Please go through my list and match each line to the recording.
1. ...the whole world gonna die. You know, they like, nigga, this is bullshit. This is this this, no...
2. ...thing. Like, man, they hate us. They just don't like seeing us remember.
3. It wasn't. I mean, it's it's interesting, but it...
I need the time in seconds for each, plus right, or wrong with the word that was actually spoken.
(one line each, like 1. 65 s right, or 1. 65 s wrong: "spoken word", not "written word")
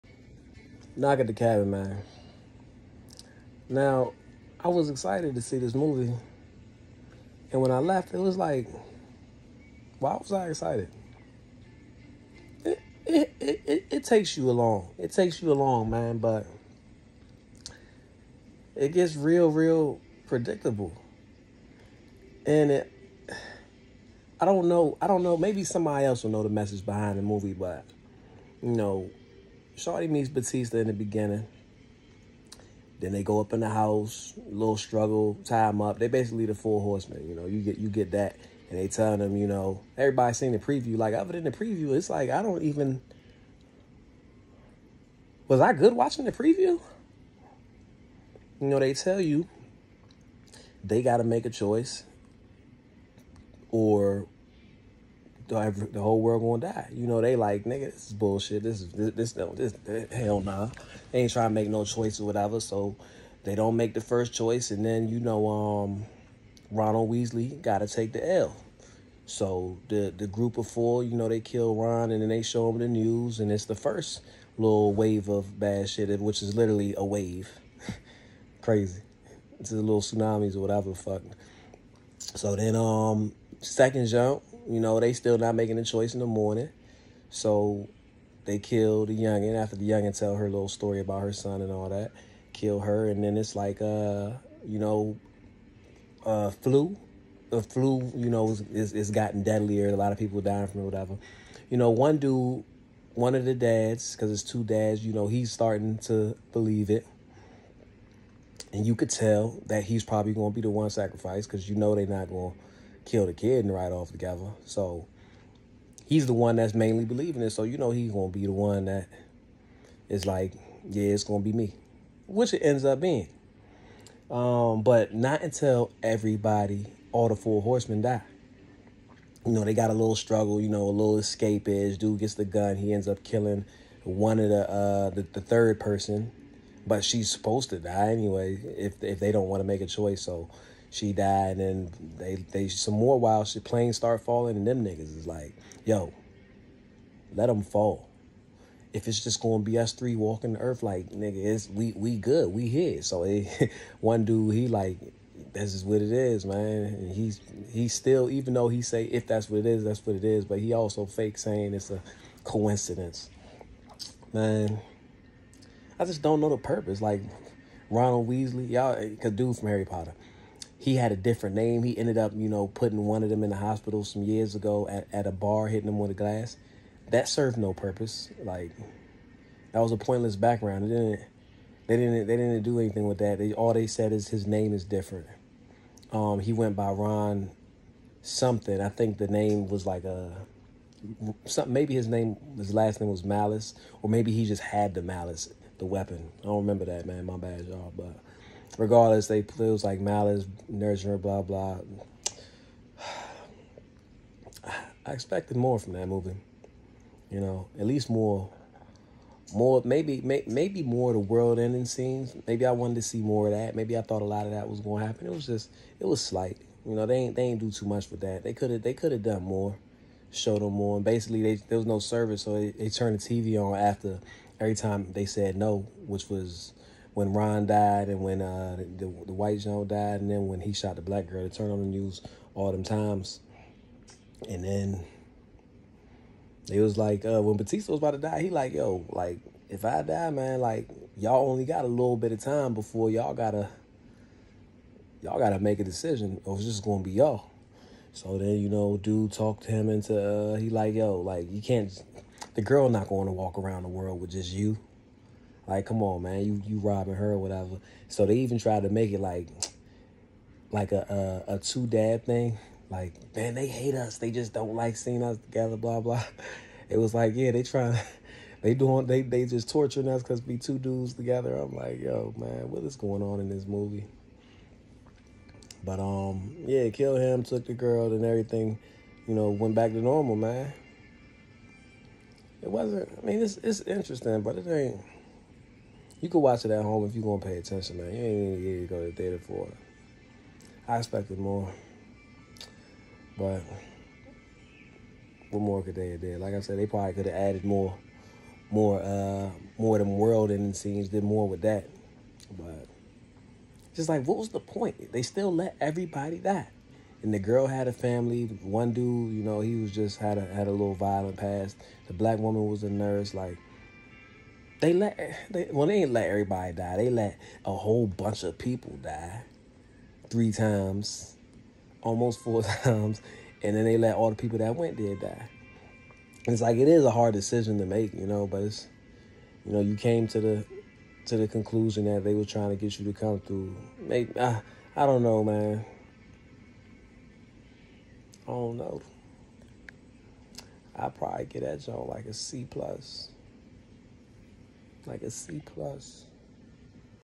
1. 55 s right
2. 262 s wrong: "together", not "remember"
3. 282 s right.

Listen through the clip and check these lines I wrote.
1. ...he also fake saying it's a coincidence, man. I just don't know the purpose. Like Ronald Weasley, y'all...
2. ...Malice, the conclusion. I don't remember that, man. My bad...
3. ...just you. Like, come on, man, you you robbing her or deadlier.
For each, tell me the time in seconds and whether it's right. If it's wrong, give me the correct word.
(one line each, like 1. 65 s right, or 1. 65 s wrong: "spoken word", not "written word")
1. 160 s right
2. 195 s wrong: "weapon", not "conclusion"
3. 254 s wrong: "whatever", not "deadlier".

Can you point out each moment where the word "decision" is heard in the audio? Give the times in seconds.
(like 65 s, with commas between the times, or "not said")
245 s, 327 s.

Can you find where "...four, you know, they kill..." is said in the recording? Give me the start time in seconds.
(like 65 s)
70 s.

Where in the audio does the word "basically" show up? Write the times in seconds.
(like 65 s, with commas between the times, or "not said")
36 s, 221 s.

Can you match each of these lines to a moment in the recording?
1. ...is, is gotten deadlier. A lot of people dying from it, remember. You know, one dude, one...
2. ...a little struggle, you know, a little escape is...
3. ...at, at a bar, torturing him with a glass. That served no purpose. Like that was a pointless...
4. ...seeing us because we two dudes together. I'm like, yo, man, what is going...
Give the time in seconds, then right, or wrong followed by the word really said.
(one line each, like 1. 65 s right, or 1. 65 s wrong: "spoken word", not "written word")
1. 98 s wrong: "whatever", not "remember"
2. 129 s right
3. 174 s wrong: "hitting", not "torturing"
4. 269 s wrong: "torturing", not "seeing".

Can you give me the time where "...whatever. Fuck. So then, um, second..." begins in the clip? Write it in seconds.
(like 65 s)
80 s.